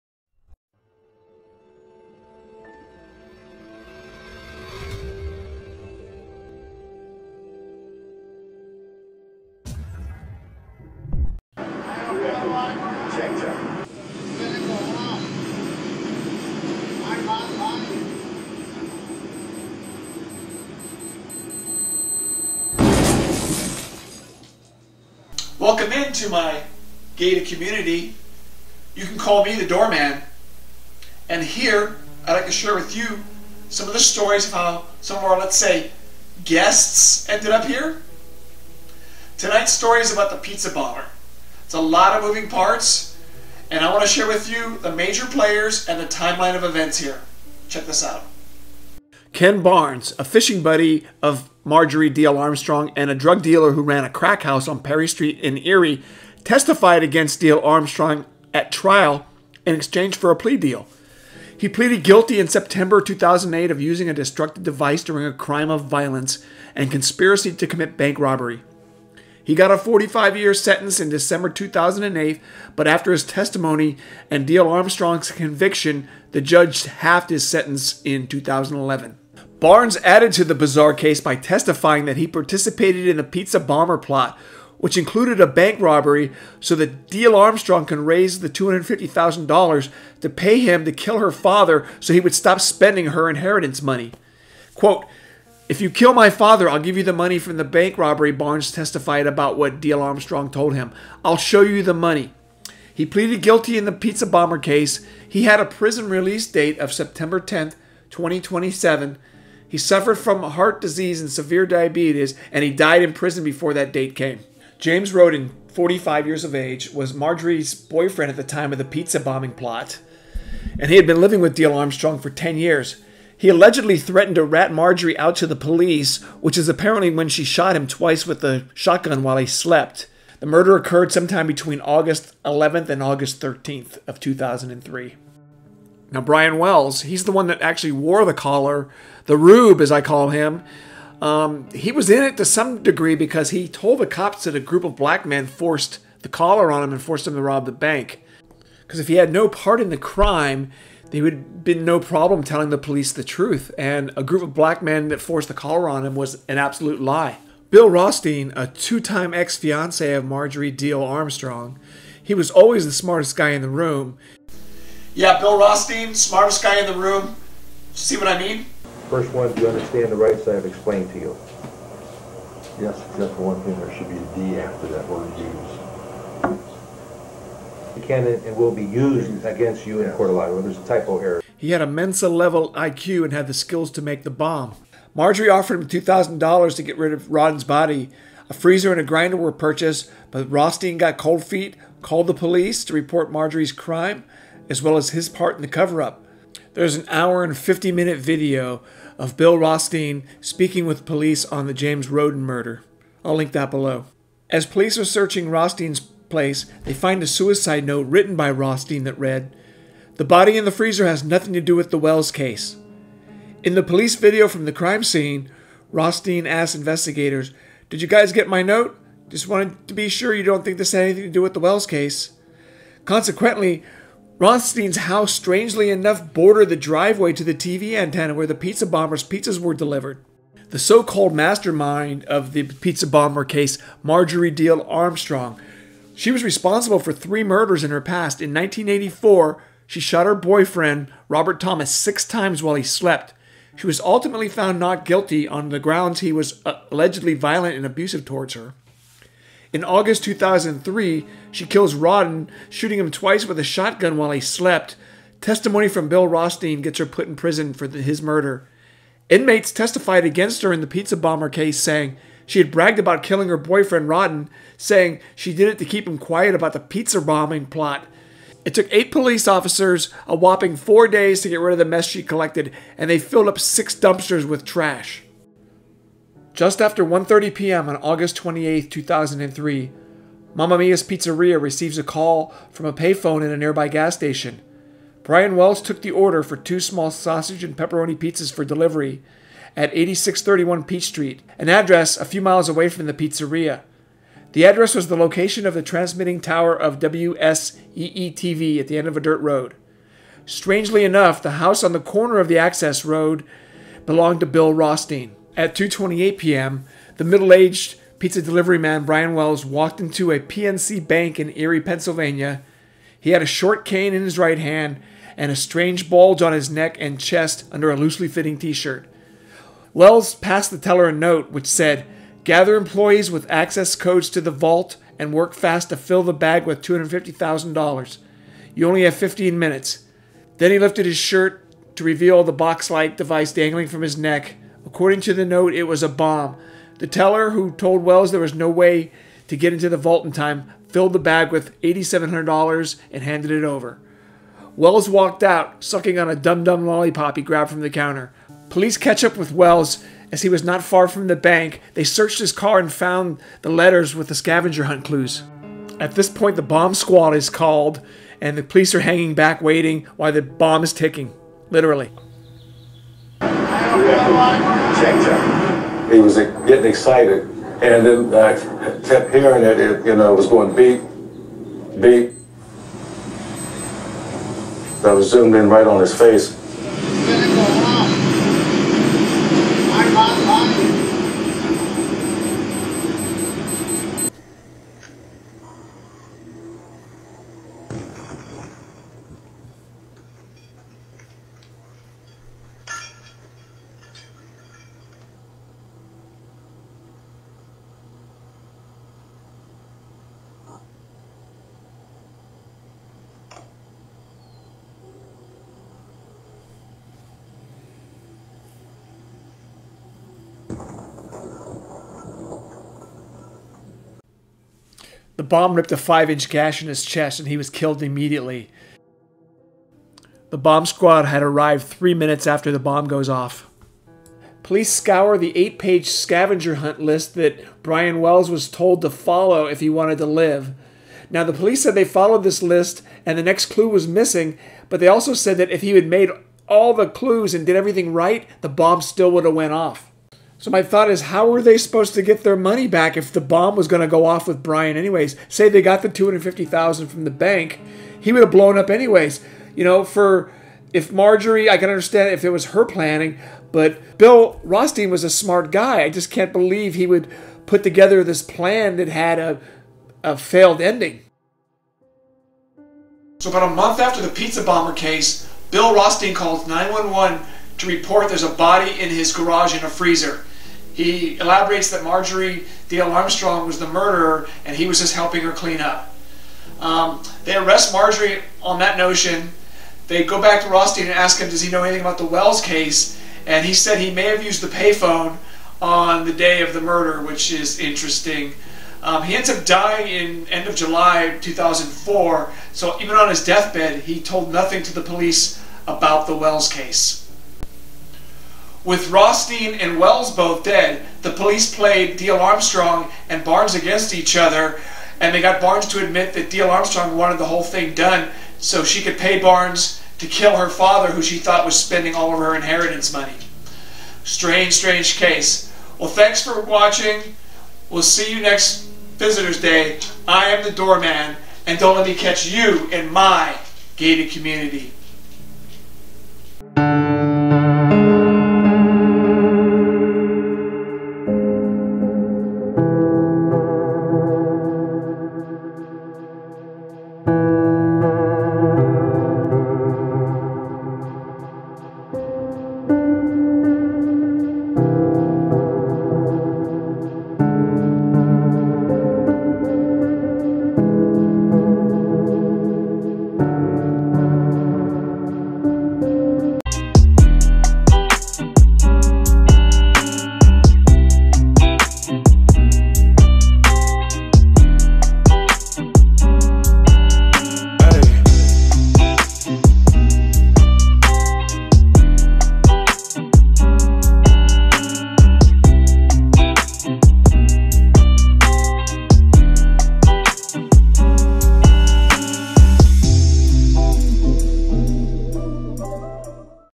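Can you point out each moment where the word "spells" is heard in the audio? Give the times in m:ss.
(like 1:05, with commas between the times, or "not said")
not said.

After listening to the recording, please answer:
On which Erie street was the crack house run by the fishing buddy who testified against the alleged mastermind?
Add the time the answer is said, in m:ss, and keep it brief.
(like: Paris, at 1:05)
Perry Street, at 0:54.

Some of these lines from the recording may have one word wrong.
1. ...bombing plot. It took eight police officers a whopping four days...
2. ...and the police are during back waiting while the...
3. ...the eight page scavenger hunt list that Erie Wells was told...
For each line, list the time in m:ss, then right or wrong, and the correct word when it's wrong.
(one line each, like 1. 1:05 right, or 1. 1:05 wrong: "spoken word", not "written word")
1. 4:27 right
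2. 5:58 wrong: "hanging", not "during"
3. 7:05 wrong: "Brian", not "Erie".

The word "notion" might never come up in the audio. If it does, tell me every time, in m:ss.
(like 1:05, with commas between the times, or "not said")
7:58.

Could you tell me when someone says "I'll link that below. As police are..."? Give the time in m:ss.
3:23.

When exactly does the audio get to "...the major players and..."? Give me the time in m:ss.
0:44.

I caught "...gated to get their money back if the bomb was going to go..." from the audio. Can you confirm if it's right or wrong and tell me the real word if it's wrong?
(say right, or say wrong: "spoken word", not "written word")
wrong: "supposed", not "gated".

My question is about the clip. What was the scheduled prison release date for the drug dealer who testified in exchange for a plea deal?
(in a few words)
September 10, 2027.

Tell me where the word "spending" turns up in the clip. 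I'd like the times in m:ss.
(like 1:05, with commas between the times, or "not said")
1:32, 8:31.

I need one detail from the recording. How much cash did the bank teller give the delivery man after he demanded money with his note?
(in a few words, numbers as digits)
$8,700.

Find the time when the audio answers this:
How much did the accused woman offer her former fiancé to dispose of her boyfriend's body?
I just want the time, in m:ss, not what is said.
3:06.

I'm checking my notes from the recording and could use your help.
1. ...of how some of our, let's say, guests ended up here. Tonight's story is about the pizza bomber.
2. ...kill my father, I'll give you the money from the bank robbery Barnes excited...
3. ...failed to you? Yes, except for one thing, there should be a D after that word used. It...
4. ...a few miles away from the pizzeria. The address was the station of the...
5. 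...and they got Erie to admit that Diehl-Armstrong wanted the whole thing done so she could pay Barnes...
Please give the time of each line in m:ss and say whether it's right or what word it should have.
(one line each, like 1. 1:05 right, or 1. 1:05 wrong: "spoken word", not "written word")
1. 0:34 right
2. 1:35 wrong: "testified", not "excited"
3. 2:50 wrong: "explained", not "failed"
4. 4:52 wrong: "location", not "station"
5. 8:25 wrong: "Barnes", not "Erie".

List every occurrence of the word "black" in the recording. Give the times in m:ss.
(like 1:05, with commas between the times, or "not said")
2:24, 2:34.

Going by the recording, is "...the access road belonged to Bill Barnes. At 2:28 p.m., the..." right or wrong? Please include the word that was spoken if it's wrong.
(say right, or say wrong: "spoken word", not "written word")
wrong: "Rothstein", not "Barnes".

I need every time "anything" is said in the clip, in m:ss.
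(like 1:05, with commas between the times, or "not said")
3:41, 8:01.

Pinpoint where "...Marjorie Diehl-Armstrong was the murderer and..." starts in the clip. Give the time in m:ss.
7:52.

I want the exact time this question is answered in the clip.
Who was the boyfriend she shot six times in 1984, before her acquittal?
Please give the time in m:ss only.
4:01.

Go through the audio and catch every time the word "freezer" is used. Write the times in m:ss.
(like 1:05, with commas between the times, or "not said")
3:08, 3:30, 7:49.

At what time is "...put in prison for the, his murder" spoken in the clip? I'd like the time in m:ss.
4:17.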